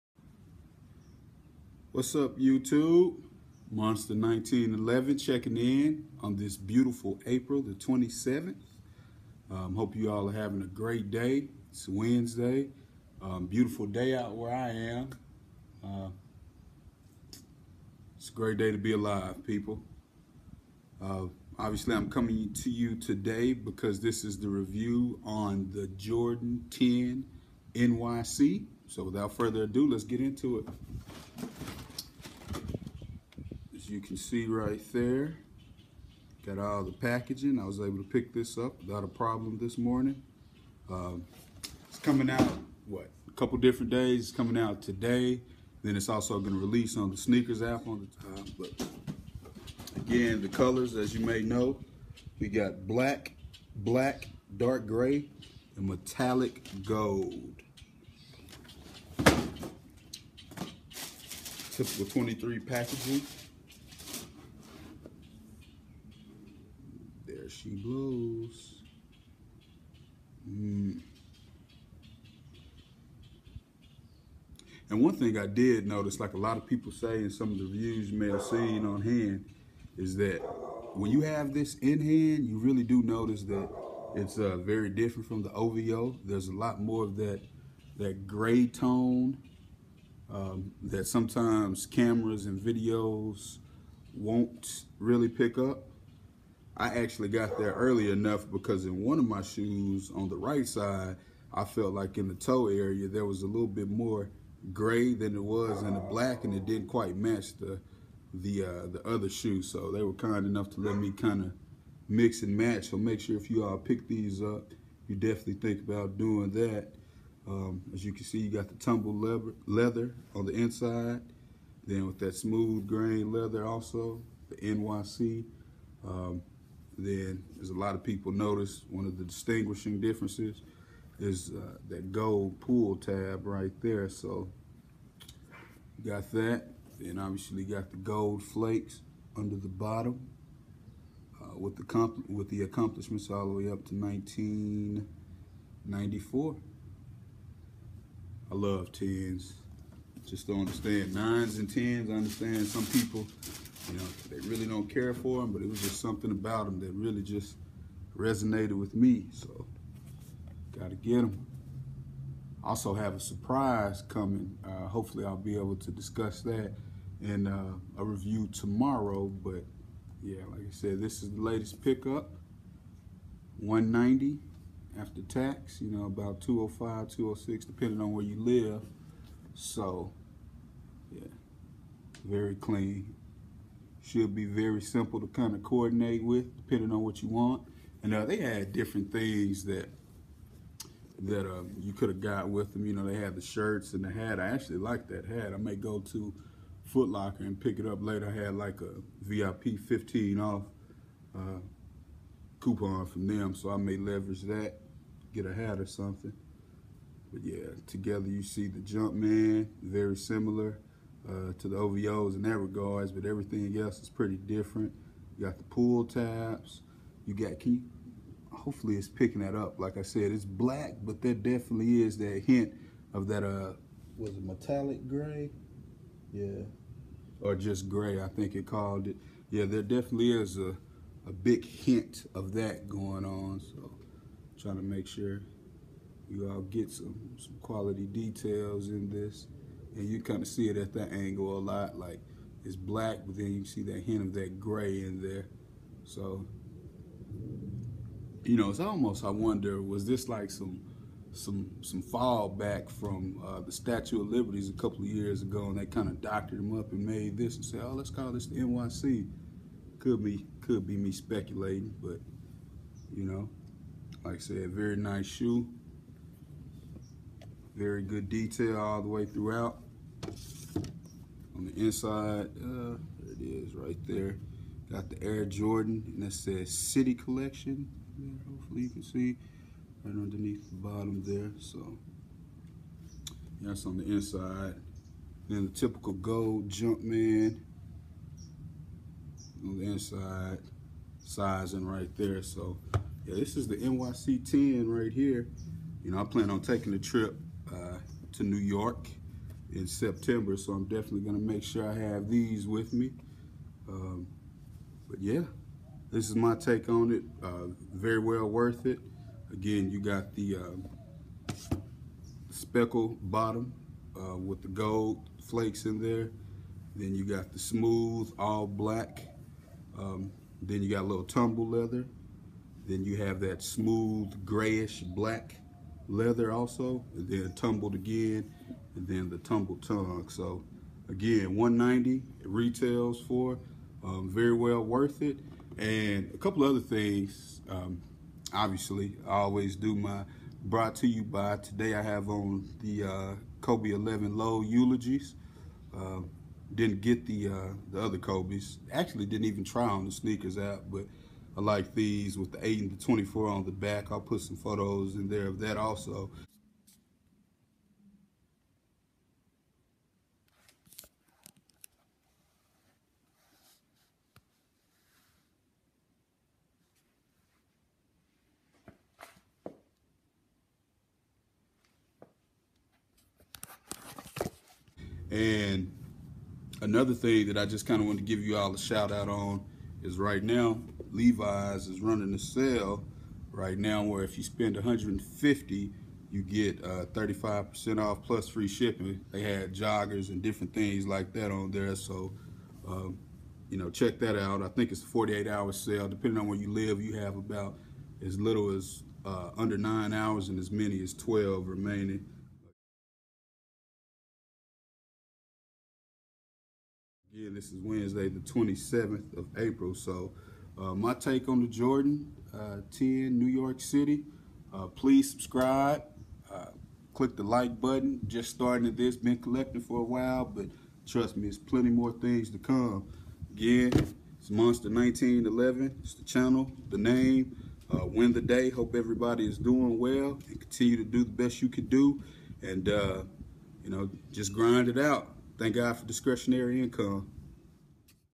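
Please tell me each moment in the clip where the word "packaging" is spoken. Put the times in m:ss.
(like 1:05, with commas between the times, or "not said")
0:36, 1:02.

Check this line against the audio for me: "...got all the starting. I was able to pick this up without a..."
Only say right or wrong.
wrong.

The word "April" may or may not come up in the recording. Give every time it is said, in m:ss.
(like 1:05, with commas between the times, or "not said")
0:07, 6:49.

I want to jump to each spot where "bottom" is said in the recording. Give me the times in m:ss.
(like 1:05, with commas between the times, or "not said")
2:19, 4:40, 5:13.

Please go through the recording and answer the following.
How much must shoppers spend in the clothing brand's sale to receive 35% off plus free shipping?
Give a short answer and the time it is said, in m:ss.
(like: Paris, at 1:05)
150, at 6:24.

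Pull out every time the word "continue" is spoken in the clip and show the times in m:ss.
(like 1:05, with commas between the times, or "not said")
7:10.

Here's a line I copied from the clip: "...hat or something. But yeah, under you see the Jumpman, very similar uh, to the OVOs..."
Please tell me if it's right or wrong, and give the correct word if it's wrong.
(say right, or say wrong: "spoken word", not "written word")
wrong: "together", not "under".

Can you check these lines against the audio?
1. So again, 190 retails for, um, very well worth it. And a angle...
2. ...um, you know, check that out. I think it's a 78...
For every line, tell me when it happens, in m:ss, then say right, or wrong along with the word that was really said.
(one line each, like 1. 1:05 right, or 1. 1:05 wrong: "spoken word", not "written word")
1. 5:30 wrong: "couple", not "angle"
2. 6:32 wrong: "48", not "78".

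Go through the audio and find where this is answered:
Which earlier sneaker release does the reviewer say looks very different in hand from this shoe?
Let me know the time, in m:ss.
1:25.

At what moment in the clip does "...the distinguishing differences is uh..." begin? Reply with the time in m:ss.
2:09.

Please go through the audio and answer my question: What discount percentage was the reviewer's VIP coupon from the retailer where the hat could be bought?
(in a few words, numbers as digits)
15.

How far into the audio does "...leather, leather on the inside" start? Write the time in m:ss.
1:59.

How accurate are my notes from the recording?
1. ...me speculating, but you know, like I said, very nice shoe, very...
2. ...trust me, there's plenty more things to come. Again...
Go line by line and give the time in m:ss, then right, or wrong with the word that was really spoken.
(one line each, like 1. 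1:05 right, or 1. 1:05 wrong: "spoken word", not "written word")
1. 4:20 right
2. 7:01 right.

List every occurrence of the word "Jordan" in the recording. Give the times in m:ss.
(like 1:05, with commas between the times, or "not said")
0:25, 4:35, 6:51.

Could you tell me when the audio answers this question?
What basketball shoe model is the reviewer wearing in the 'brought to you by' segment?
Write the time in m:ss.
5:43.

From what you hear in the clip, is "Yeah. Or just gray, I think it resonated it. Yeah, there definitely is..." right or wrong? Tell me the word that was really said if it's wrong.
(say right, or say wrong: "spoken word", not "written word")
wrong: "called", not "resonated".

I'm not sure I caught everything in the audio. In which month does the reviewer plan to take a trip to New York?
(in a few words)
September.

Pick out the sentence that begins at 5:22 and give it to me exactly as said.
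Then you have that smooth, grayish black leather also.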